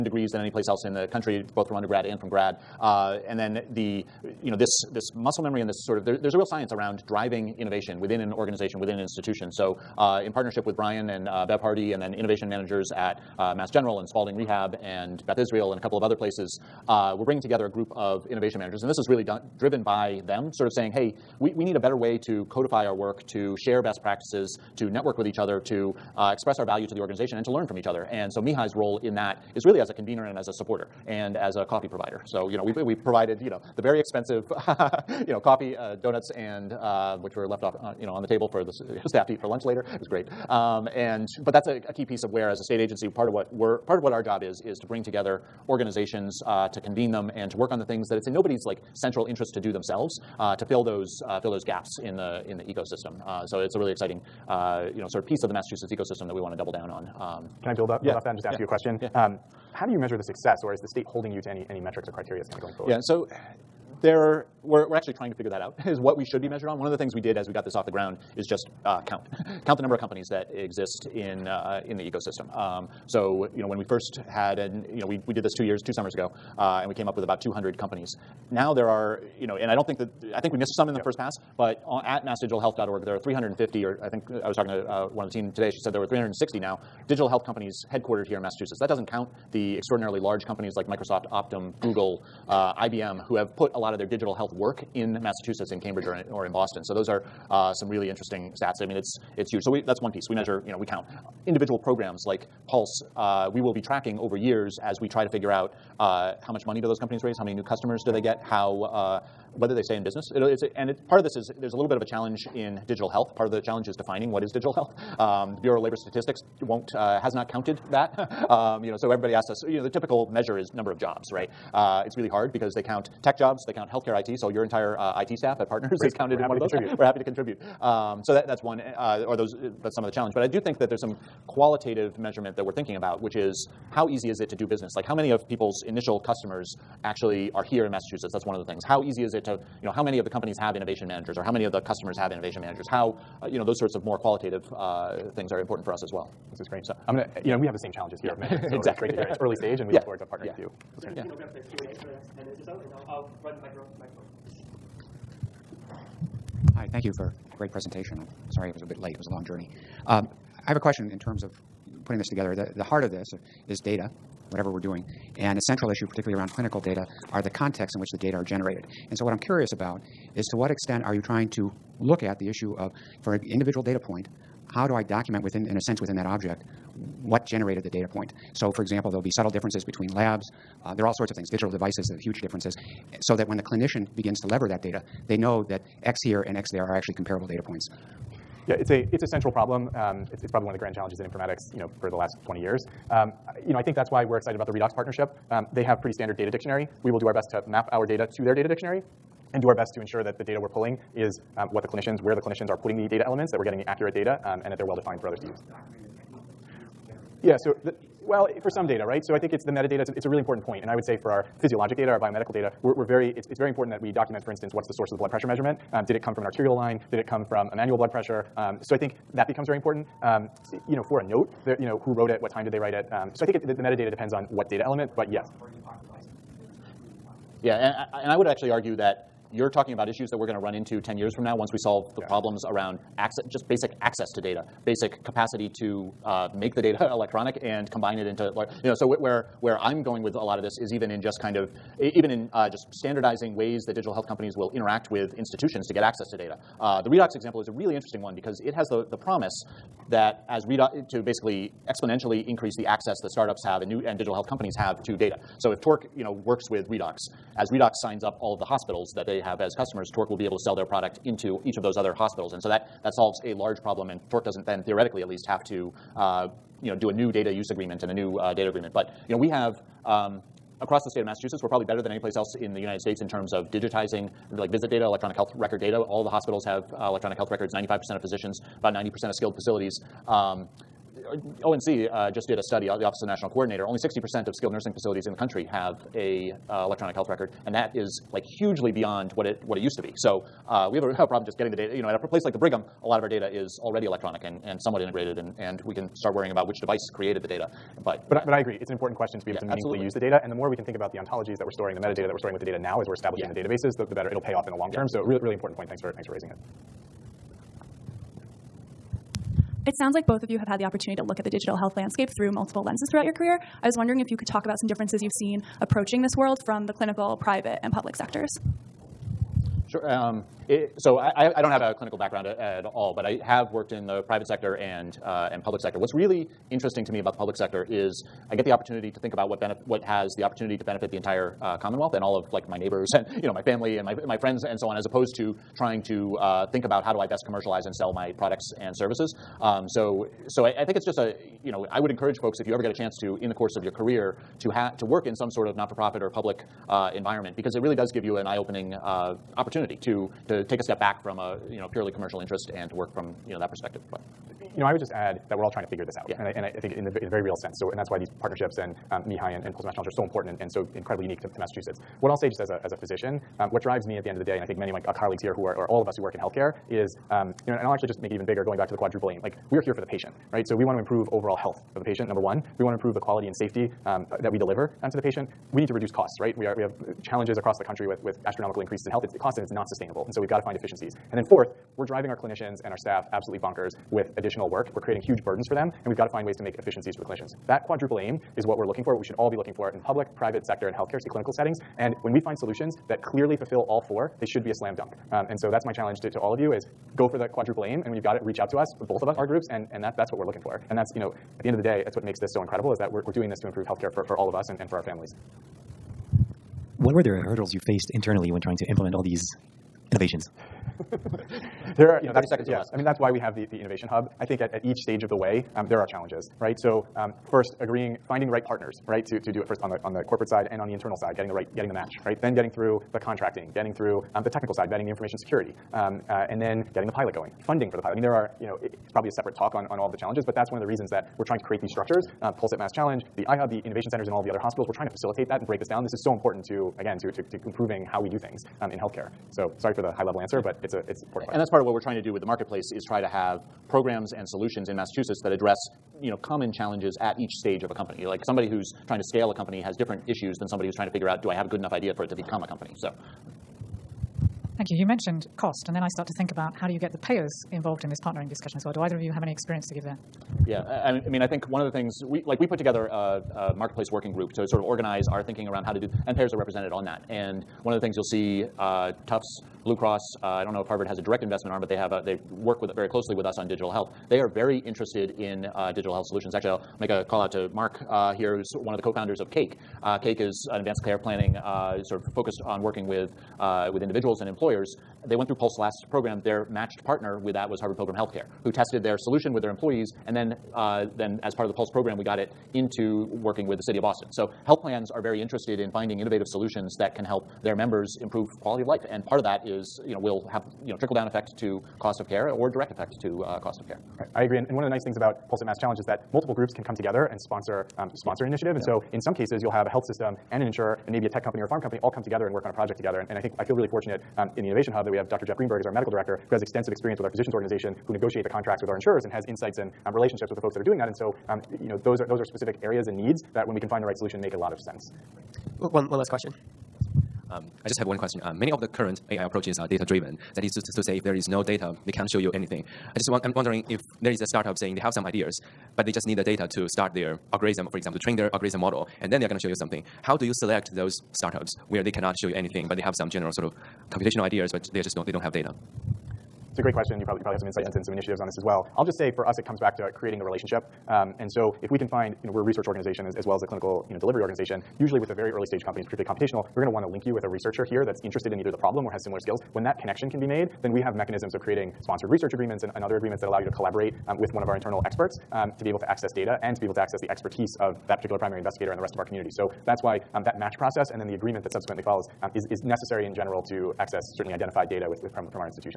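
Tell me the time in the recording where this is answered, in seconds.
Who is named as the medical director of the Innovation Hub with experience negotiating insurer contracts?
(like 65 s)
515 s.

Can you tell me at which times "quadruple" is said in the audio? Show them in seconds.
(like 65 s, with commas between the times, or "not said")
368 s, 387 s, 397 s.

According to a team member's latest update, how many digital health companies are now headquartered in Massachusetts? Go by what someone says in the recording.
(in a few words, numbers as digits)
360.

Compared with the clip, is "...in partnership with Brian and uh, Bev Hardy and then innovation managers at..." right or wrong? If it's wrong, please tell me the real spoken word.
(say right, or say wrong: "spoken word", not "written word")
right.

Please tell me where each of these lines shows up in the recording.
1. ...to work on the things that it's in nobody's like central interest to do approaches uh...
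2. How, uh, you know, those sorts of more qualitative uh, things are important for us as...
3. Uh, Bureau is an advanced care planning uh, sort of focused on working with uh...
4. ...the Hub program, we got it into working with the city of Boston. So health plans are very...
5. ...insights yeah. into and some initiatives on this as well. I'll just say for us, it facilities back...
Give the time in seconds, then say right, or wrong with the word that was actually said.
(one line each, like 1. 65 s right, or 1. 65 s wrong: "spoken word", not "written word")
1. 47 s wrong: "themselves", not "approaches"
2. 142 s right
3. 480 s wrong: "Cake", not "Bureau"
4. 491 s wrong: "Pulse", not "Hub"
5. 547 s wrong: "comes", not "facilities".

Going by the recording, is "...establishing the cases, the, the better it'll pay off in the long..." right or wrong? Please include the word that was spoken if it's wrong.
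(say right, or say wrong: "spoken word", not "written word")
wrong: "databases", not "cases".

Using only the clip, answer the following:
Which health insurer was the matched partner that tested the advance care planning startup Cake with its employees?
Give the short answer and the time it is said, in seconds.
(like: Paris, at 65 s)
Harvard Pilgrim Healthcare, at 487 s.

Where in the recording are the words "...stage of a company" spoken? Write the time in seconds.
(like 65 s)
447 s.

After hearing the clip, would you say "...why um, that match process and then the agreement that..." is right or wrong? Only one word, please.
right.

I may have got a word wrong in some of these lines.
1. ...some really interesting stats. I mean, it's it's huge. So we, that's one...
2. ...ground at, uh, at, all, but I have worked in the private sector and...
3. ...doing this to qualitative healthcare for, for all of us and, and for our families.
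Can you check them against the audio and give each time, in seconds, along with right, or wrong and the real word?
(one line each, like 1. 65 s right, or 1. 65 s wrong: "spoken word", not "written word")
1. 97 s right
2. 322 s wrong: "background", not "ground"
3. 403 s wrong: "improve", not "qualitative".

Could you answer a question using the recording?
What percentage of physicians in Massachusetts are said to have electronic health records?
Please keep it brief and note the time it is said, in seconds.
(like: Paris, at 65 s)
95%, at 277 s.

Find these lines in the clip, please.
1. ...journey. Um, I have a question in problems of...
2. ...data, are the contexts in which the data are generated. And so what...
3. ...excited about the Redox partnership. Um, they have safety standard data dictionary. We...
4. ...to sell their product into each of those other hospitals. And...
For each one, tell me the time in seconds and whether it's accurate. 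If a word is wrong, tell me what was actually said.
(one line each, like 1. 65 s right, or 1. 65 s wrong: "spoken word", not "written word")
1. 159 s wrong: "terms", not "problems"
2. 166 s right
3. 194 s wrong: "pretty", not "safety"
4. 260 s right.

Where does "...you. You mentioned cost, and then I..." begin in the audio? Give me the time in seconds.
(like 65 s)
454 s.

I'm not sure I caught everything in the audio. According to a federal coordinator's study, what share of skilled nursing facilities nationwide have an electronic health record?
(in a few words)
60%.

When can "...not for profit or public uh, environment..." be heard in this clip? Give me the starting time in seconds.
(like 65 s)
345 s.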